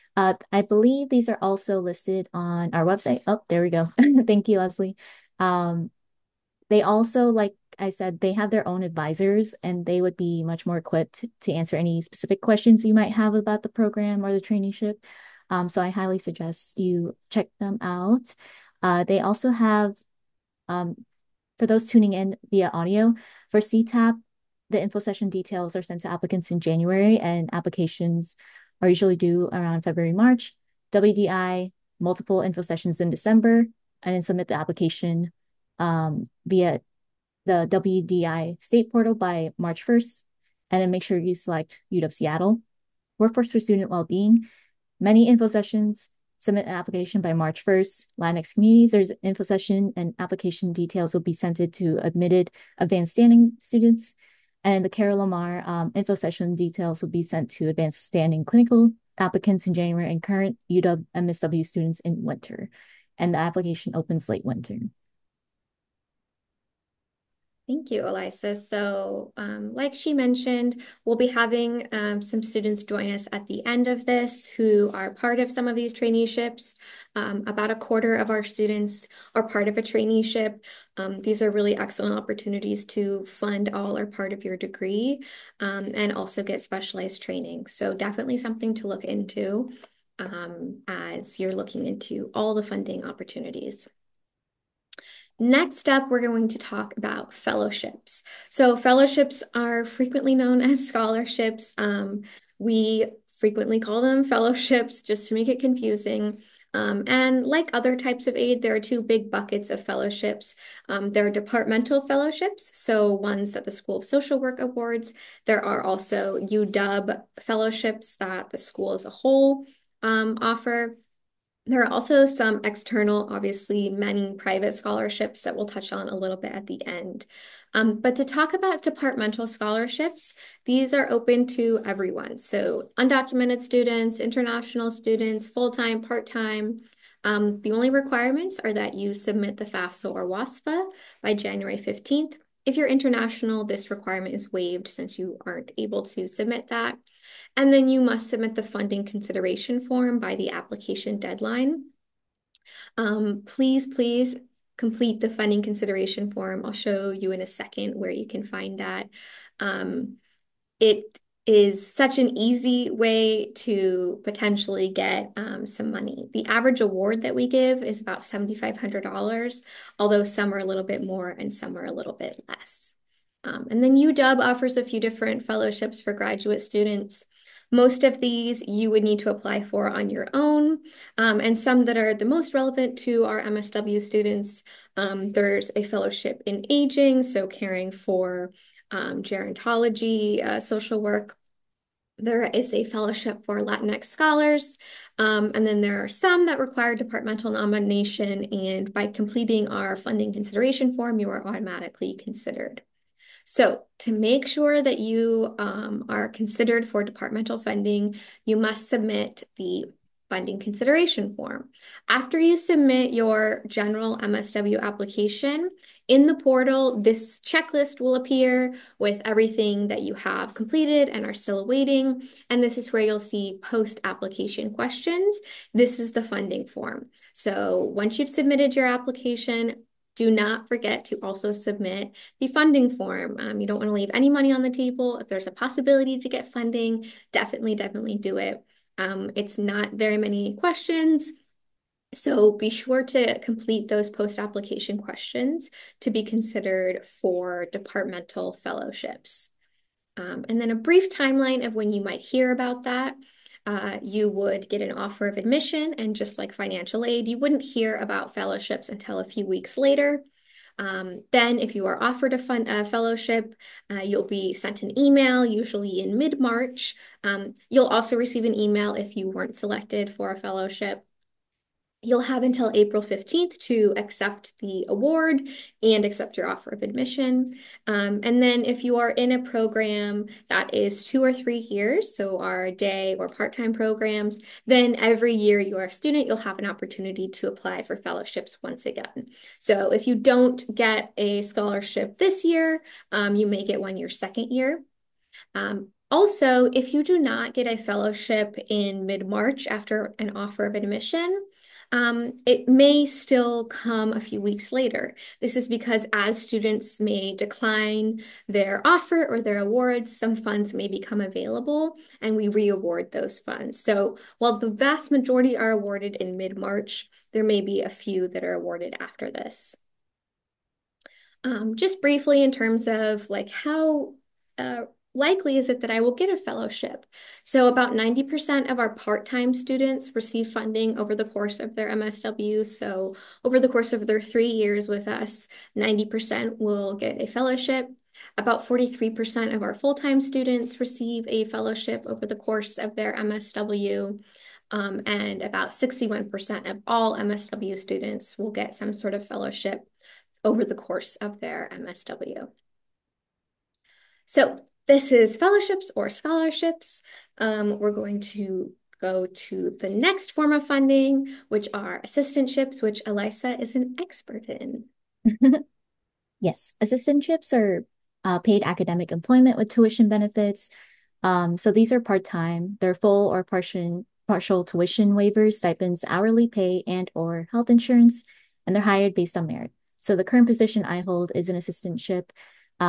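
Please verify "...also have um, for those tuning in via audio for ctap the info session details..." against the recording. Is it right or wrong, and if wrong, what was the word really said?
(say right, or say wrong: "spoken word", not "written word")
right.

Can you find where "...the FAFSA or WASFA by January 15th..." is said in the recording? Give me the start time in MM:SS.
02:19.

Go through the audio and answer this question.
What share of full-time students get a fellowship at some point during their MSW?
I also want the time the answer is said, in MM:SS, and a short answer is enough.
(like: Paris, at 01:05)
43%, at 05:38.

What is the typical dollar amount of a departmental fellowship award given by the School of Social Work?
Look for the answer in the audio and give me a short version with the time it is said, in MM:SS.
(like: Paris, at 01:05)
$7,500, at 02:48.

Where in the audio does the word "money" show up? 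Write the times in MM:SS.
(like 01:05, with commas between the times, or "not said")
02:45, 03:54.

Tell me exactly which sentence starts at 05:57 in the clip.
Um, we're going to go to the next form of funding, which are assistantships, which Elisa is an expert in.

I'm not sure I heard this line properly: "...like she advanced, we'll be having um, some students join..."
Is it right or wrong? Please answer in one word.
wrong.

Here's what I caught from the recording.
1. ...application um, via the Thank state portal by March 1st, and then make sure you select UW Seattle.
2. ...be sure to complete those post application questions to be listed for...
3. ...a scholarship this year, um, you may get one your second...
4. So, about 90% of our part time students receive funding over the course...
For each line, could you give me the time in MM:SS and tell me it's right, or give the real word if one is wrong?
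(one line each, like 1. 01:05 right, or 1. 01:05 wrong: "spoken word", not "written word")
1. 00:34 wrong: "WDI", not "Thank"
2. 04:02 wrong: "considered", not "listed"
3. 04:51 right
4. 05:27 right.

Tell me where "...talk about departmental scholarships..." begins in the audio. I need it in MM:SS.
02:08.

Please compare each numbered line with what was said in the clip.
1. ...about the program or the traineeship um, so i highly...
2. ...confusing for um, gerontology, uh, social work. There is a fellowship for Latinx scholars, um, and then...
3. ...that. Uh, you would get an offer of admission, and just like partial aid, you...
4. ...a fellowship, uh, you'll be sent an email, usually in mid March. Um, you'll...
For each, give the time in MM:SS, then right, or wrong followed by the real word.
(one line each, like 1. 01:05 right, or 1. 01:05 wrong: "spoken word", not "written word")
1. 00:13 right
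2. 03:07 wrong: "caring", not "confusing"
3. 04:12 wrong: "financial", not "partial"
4. 04:22 right.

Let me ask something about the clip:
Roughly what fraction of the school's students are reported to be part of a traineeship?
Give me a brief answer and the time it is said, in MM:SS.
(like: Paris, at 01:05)
a quarter, at 01:17.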